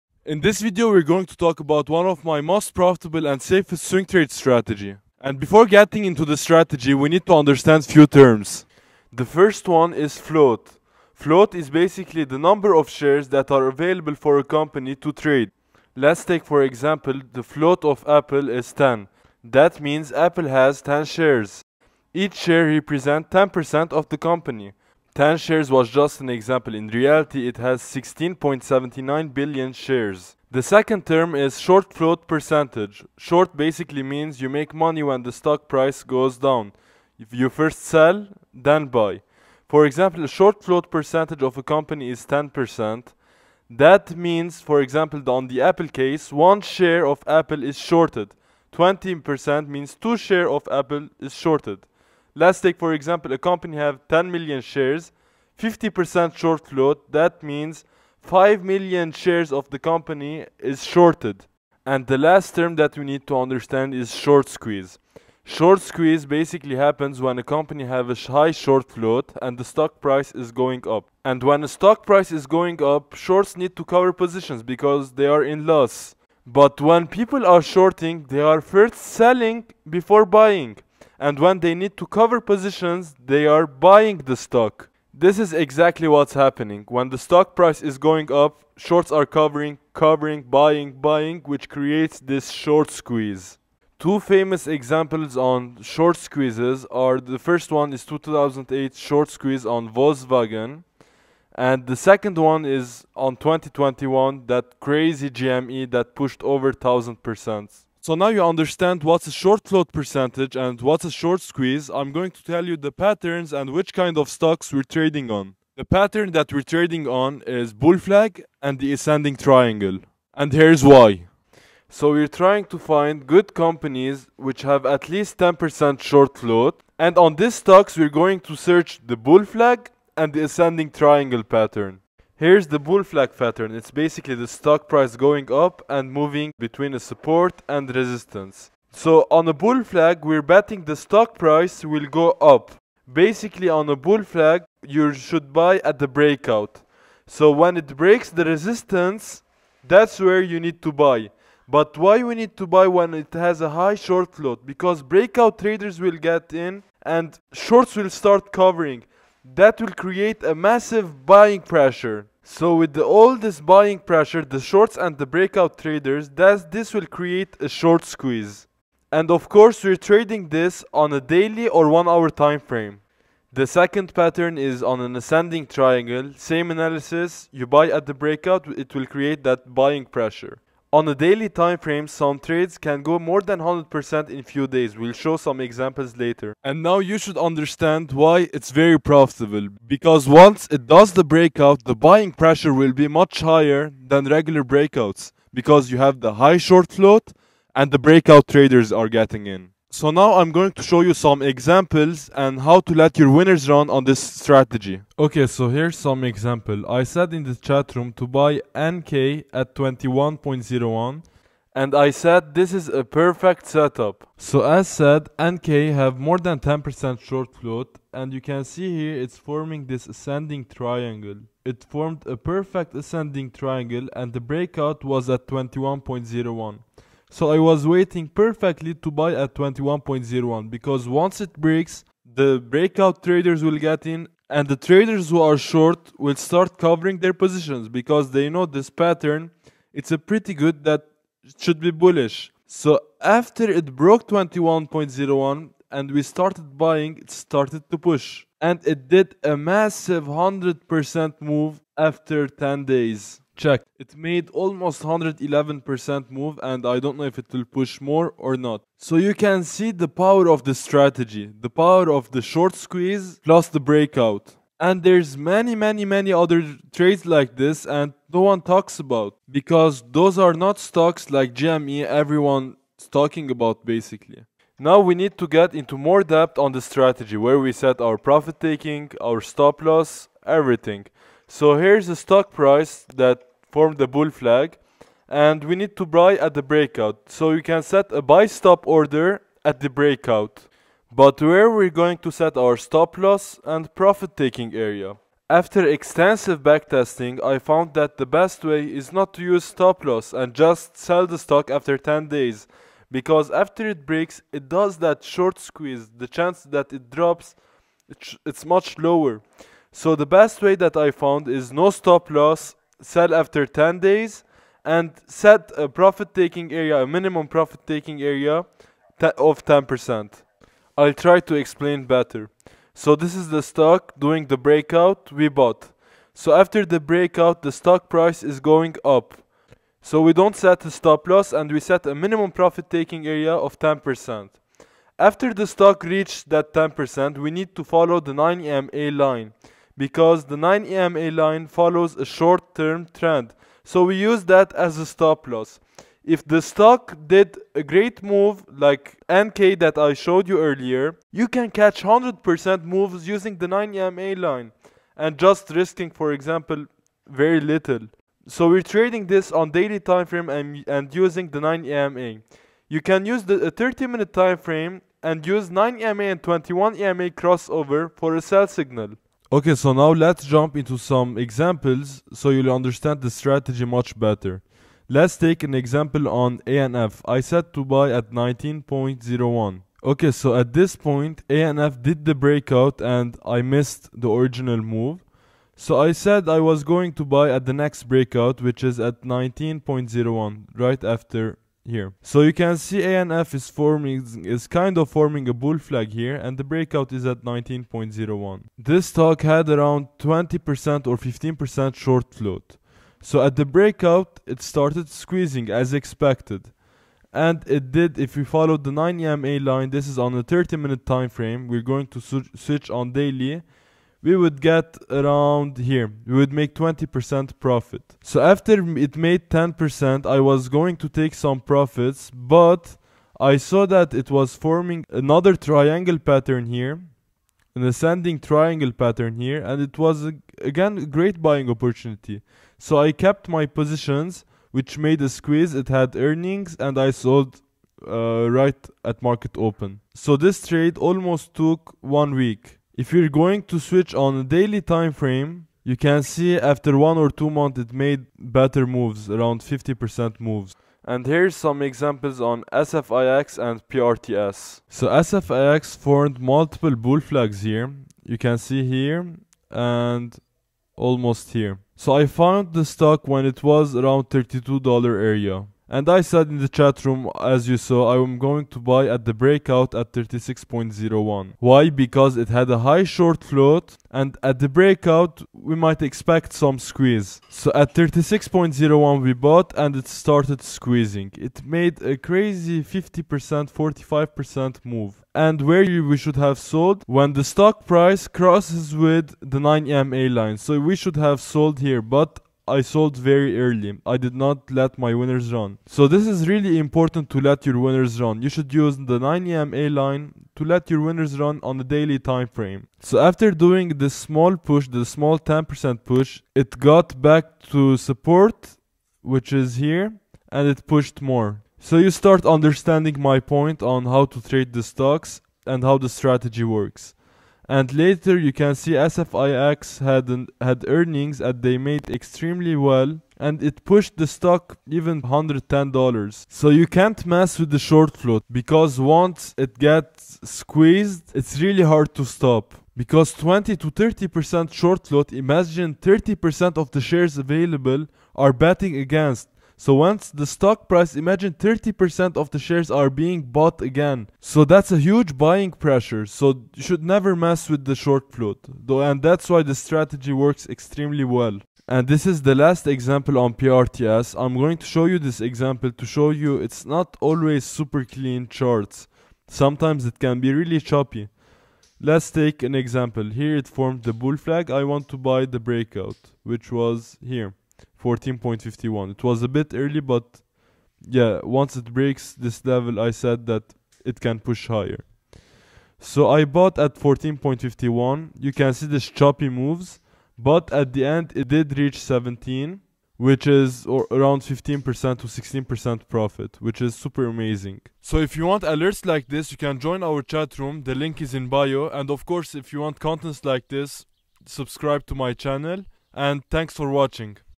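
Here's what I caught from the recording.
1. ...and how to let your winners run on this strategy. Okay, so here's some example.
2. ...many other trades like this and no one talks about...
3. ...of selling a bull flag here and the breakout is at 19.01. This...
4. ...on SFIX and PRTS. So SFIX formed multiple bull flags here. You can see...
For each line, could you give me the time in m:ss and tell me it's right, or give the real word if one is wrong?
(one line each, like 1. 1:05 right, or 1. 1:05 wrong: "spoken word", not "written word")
1. 3:22 right
2. 4:26 right
3. 6:34 wrong: "forming", not "selling"
4. 7:32 right.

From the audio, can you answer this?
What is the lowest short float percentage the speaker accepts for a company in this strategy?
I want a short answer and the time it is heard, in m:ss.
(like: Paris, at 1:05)
10%, at 2:04.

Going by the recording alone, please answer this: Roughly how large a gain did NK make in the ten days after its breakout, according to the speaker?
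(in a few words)
111%.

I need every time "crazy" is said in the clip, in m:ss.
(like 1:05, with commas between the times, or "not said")
1:44, 8:02.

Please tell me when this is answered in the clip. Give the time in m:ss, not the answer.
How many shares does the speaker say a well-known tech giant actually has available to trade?
0:27.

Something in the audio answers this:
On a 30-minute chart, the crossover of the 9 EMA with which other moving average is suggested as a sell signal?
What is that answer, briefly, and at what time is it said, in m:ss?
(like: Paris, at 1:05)
21 EMA, at 6:06.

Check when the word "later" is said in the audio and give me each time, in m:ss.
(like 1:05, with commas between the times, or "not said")
3:06, 8:37.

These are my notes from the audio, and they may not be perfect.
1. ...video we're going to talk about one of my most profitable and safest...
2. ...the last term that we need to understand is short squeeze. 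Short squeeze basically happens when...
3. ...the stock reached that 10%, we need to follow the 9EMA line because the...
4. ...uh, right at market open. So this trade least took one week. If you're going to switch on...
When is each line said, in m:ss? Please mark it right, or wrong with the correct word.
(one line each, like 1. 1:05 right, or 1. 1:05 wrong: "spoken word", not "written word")
1. 0:00 right
2. 1:02 right
3. 5:35 right
4. 7:18 wrong: "almost", not "least".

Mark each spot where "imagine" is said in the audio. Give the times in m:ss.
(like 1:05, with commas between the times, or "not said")
8:55, 9:01.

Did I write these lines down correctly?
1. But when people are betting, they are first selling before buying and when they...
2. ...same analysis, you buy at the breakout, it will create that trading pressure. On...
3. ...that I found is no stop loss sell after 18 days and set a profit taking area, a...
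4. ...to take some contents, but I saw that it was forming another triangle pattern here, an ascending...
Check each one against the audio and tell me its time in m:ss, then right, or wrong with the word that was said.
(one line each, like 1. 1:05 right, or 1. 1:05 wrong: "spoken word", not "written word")
1. 1:16 wrong: "shorting", not "betting"
2. 2:56 wrong: "buying", not "trading"
3. 5:10 wrong: "10", not "18"
4. 7:00 wrong: "profits", not "contents".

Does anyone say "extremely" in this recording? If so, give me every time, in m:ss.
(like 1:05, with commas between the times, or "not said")
8:42, 9:10.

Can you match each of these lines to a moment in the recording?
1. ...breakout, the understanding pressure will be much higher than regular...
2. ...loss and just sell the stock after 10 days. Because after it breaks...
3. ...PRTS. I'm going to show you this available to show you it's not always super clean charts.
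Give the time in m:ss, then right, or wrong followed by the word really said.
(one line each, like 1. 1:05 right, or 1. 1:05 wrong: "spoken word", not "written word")
1. 3:11 wrong: "buying", not "understanding"
2. 5:00 right
3. 9:13 wrong: "example", not "available".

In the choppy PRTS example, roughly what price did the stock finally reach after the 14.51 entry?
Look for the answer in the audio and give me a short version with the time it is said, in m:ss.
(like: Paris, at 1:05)
17, at 9:41.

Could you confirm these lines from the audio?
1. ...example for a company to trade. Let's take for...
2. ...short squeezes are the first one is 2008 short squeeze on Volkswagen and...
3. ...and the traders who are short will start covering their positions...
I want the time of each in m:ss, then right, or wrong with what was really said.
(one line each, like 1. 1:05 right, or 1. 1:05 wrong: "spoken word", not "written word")
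1. 0:13 wrong: "available", not "example"
2. 1:35 right
3. 3:54 right.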